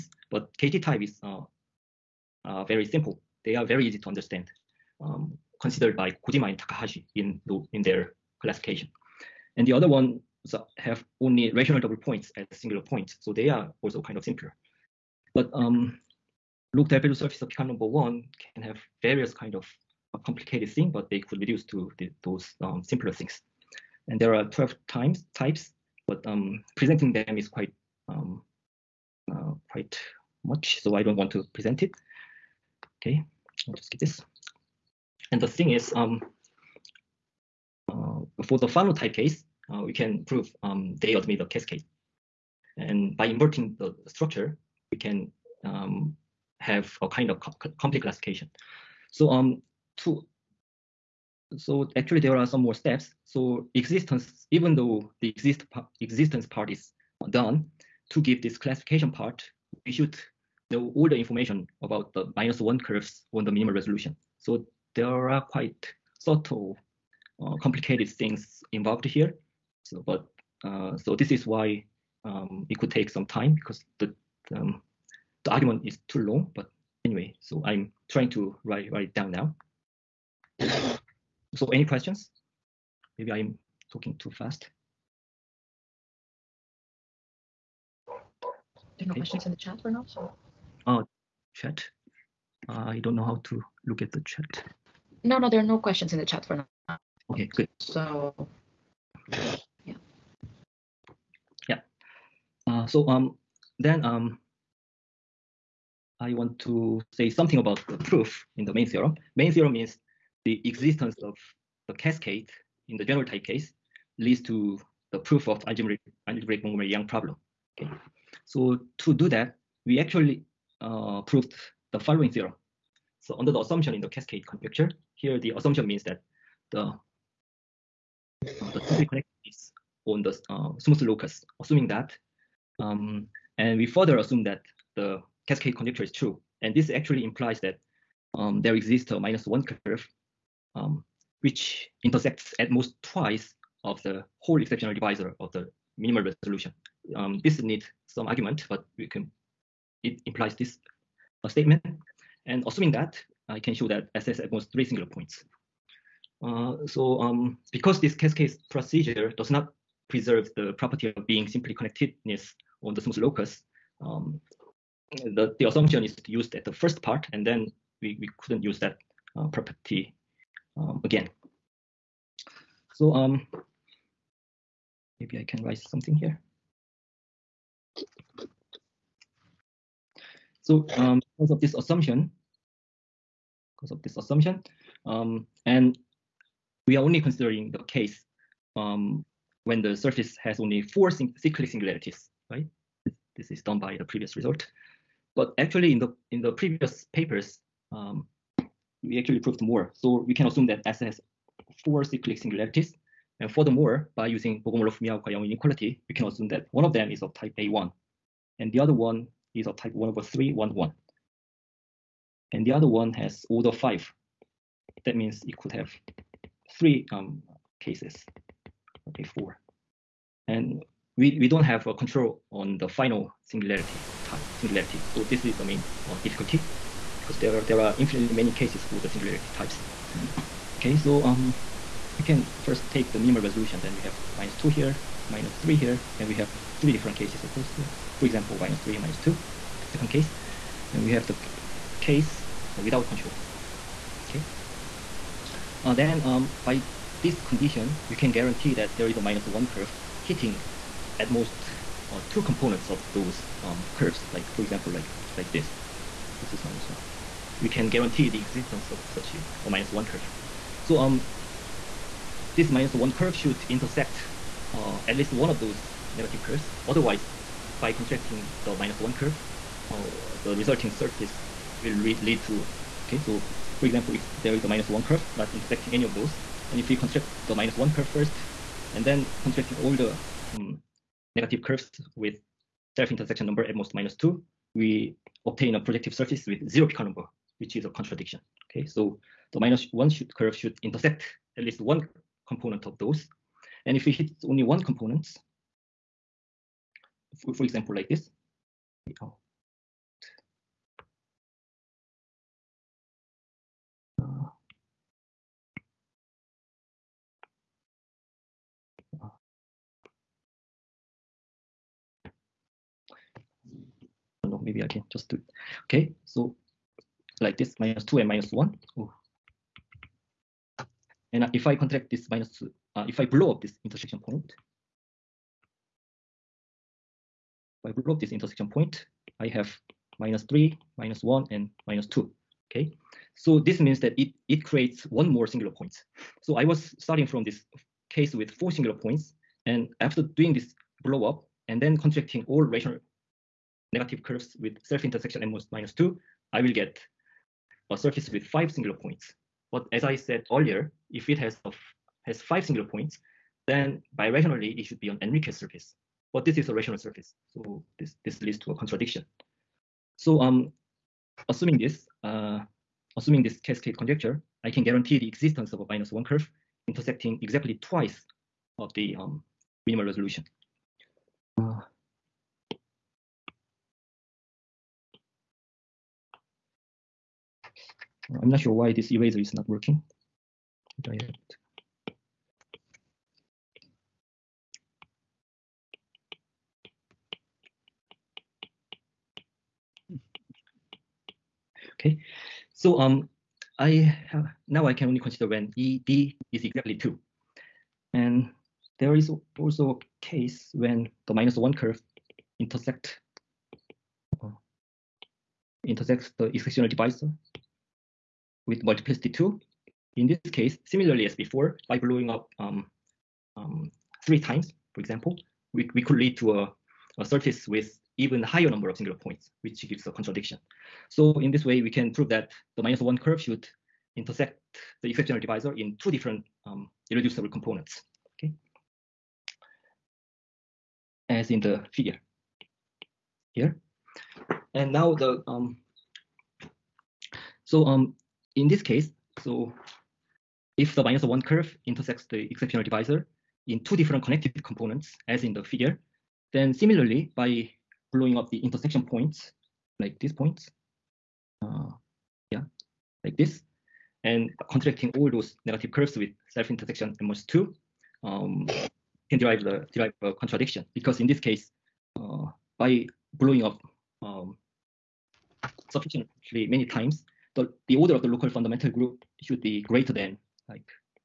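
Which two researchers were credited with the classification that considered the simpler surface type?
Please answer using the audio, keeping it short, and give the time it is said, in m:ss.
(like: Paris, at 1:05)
Kojima and Takahashi, at 0:06.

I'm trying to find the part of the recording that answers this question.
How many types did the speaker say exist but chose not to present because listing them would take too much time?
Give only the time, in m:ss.
0:24.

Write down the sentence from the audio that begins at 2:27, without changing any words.
Um, this needs some argument, but we can, it implies this statement.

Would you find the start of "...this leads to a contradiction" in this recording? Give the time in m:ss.
5:58.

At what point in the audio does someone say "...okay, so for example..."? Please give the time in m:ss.
4:33.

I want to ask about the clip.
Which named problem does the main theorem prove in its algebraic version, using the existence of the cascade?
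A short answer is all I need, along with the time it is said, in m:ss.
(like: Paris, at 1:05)
Montgomery-Yang problem, at 1:56.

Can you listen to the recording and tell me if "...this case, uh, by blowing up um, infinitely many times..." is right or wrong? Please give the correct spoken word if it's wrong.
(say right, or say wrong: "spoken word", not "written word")
wrong: "sufficiently", not "infinitely".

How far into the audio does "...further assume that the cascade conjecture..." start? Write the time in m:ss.
2:13.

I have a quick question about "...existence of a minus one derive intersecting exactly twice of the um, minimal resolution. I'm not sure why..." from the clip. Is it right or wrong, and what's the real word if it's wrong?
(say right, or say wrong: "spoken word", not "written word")
wrong: "curve", not "derive".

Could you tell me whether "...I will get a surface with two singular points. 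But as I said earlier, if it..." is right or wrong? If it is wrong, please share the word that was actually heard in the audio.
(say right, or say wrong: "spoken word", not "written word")
wrong: "five", not "two".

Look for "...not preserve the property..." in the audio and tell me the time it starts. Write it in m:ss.
2:39.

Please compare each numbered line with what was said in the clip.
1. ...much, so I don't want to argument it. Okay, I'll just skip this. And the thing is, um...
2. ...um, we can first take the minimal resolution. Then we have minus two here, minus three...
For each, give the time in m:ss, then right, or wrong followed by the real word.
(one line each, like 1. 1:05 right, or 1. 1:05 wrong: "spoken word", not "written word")
1. 0:30 wrong: "present", not "argument"
2. 3:51 right.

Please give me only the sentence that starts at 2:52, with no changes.
So um, Maybe I can write something here.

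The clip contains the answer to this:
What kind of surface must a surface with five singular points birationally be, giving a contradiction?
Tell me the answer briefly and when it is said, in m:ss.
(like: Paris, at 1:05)
Enriques surface, at 5:55.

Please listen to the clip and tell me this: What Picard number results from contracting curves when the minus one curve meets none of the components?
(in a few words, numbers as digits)
0.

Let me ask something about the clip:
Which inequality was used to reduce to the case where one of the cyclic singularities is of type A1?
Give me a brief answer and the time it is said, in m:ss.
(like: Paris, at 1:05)
Bogomolov Miyaoka inequality, at 3:24.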